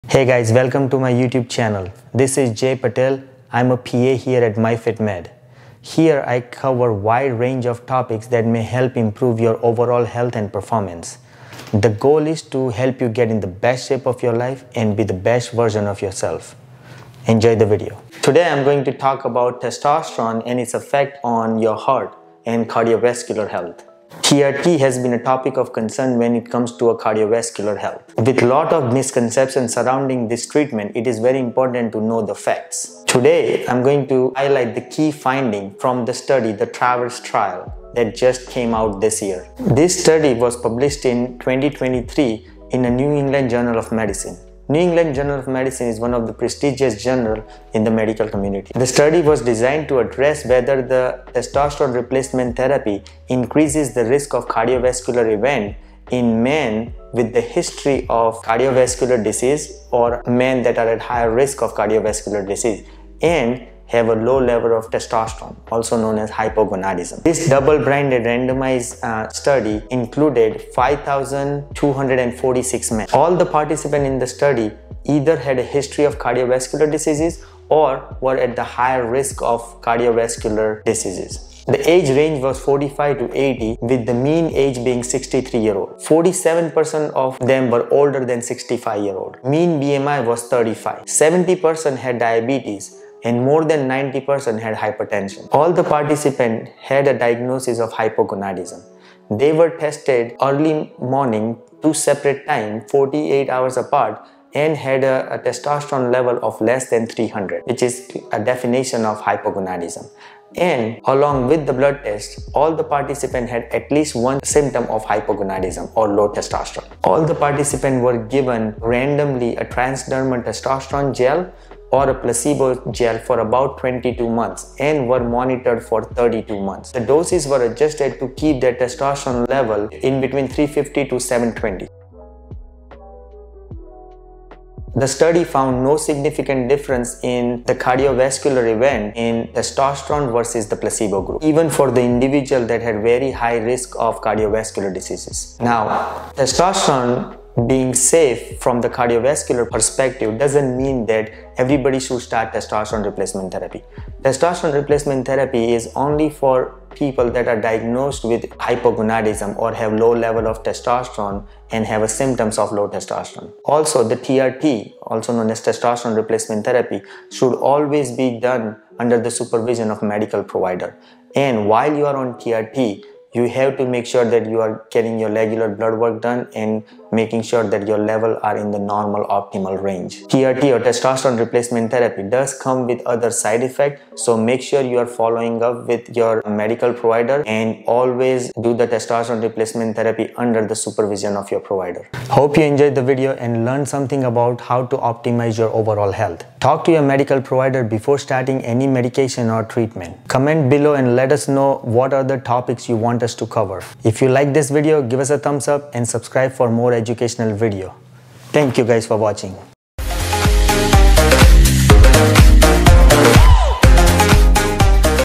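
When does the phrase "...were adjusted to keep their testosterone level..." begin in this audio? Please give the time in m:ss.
2:07.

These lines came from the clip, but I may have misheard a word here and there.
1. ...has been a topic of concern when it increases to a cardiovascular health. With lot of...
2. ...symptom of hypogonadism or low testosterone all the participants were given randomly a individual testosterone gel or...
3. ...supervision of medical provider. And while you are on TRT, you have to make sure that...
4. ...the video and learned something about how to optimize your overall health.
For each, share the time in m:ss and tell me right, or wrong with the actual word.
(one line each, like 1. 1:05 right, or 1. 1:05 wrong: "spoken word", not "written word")
1. 0:24 wrong: "comes", not "increases"
2. 1:54 wrong: "transdermal", not "individual"
3. 2:49 right
4. 3:12 right.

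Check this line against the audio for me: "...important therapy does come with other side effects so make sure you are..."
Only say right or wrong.
wrong.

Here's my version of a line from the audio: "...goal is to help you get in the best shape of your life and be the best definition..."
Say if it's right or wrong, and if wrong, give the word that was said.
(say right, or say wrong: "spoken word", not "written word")
wrong: "version", not "definition".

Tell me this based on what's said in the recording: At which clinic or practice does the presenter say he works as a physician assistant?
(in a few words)
MyFitMed.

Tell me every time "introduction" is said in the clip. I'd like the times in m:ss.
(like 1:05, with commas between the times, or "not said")
not said.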